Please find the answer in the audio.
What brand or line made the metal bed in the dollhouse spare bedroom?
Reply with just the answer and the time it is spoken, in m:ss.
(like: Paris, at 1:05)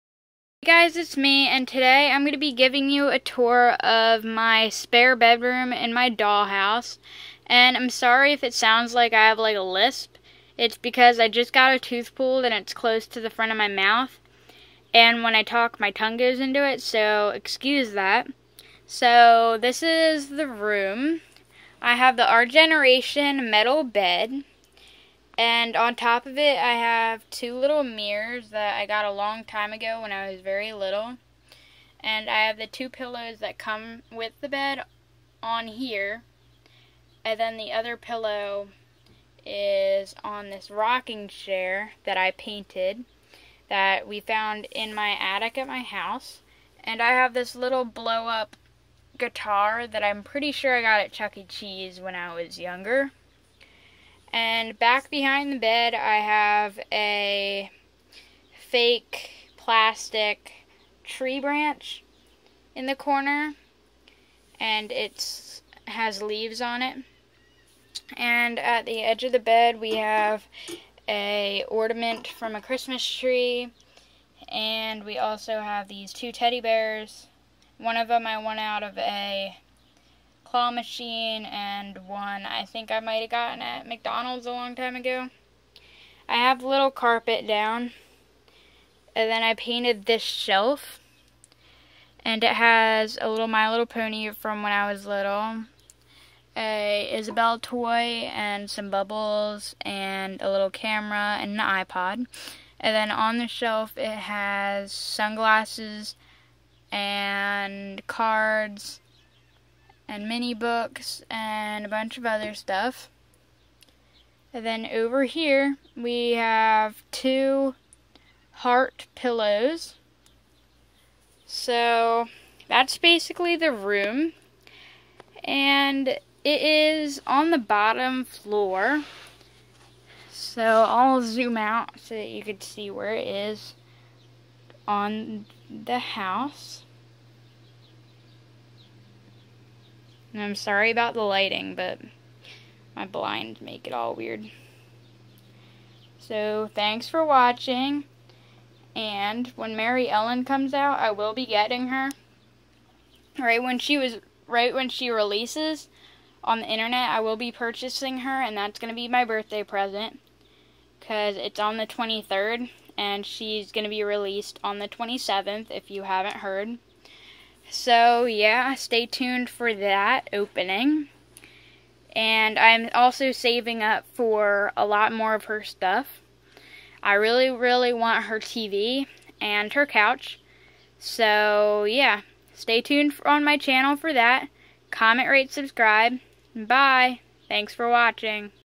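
Our Generation, at 0:22.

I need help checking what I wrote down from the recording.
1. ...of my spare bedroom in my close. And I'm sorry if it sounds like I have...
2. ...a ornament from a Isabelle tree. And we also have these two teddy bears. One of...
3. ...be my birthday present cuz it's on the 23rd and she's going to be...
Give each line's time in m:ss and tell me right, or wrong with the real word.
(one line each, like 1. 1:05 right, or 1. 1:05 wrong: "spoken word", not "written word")
1. 0:03 wrong: "dollhouse", not "close"
2. 1:11 wrong: "Christmas", not "Isabelle"
3. 2:38 right.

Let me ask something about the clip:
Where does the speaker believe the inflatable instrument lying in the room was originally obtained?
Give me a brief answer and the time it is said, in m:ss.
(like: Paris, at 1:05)
Chuck E. Cheese, at 0:51.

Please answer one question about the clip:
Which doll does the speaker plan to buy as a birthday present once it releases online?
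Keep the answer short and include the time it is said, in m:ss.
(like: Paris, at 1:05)
Maryellen, at 2:29.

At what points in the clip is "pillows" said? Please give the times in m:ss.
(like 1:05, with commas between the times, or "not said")
0:32, 0:37, 1:59.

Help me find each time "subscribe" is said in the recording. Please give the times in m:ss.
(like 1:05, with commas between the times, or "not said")
3:05.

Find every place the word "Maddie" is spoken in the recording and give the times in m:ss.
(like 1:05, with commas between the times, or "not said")
not said.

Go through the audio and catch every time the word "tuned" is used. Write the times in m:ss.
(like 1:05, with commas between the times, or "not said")
2:49, 3:02.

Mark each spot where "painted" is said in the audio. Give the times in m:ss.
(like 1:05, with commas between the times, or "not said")
0:42, 1:29.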